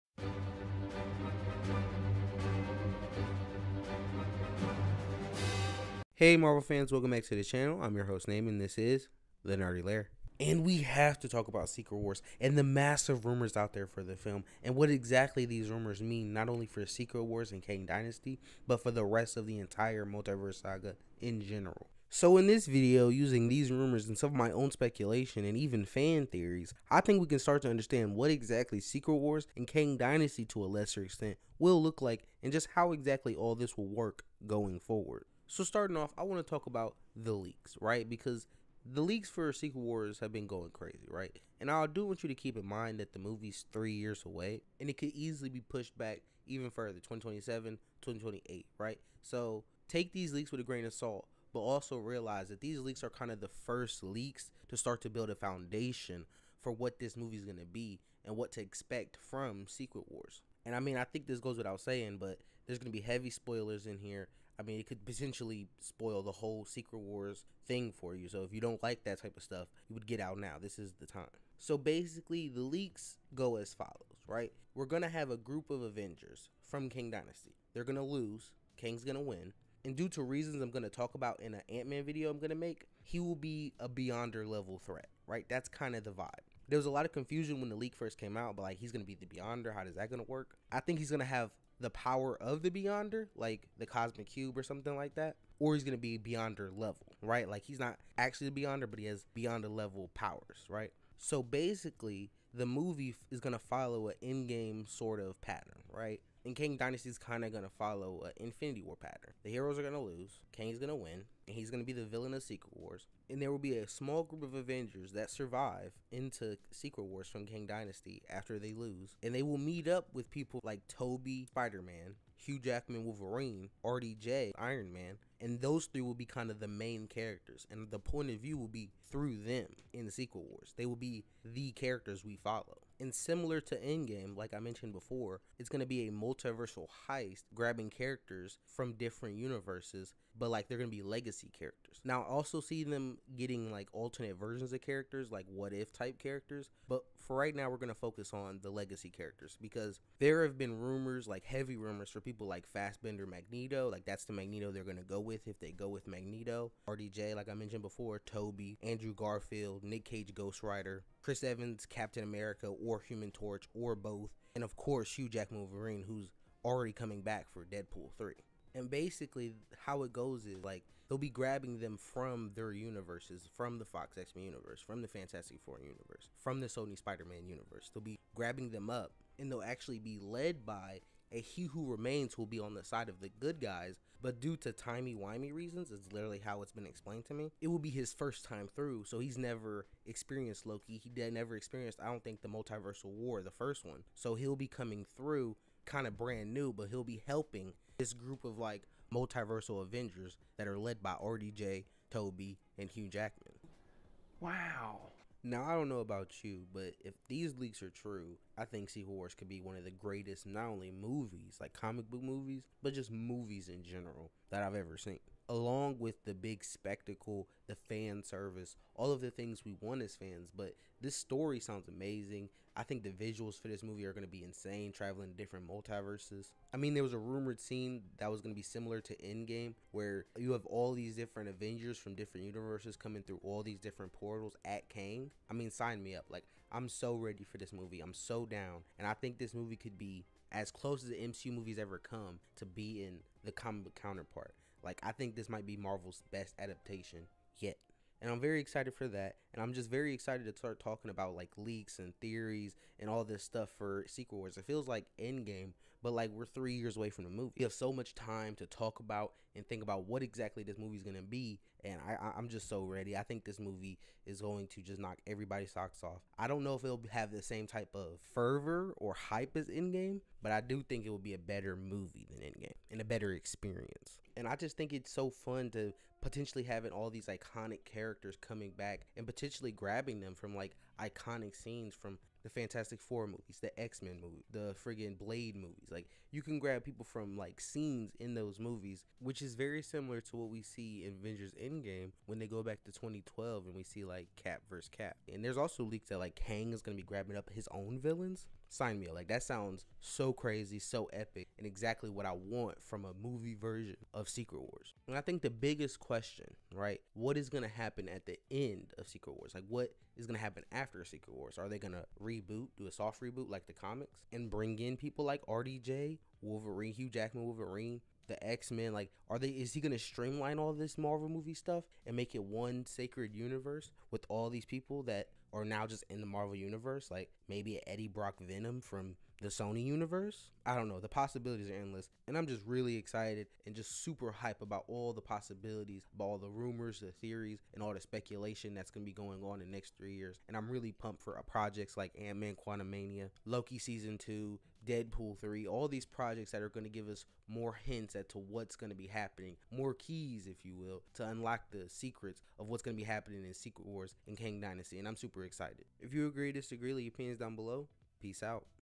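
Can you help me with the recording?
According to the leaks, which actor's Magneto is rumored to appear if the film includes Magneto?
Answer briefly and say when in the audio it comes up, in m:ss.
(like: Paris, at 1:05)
Fassbender, at 2:32.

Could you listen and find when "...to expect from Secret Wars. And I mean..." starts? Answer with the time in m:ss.
0:58.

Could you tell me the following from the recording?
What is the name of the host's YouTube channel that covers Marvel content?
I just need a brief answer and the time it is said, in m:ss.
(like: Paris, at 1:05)
The Nerdy Lair, at 0:09.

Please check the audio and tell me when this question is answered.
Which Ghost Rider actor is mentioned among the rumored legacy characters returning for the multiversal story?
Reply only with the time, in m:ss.
2:39.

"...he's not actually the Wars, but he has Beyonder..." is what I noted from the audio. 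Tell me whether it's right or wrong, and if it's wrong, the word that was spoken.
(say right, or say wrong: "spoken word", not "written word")
wrong: "Beyonder", not "Wars".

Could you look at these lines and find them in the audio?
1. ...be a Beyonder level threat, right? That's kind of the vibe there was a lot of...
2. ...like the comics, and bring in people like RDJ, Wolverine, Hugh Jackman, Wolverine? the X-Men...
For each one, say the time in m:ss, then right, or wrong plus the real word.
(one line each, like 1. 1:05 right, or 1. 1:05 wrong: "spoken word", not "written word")
1. 1:23 right
2. 5:13 right.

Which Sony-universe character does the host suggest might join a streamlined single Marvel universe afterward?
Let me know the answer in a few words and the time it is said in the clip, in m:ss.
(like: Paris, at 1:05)
Eddie Brock Venom, at 5:27.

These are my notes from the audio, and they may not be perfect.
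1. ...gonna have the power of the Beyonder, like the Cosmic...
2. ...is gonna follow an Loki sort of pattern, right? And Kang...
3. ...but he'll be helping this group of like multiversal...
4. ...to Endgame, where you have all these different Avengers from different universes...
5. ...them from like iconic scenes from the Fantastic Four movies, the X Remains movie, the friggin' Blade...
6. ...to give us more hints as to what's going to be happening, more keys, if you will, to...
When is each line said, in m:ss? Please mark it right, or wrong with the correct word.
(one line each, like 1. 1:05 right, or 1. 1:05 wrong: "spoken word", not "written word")
1. 1:31 right
2. 1:43 wrong: "Endgame", not "Loki"
3. 3:16 right
4. 3:49 right
5. 4:40 wrong: "Men", not "Remains"
6. 5:46 right.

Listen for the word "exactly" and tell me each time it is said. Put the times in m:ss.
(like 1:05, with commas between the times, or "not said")
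0:14, 0:28, 0:32, 4:20, 5:01.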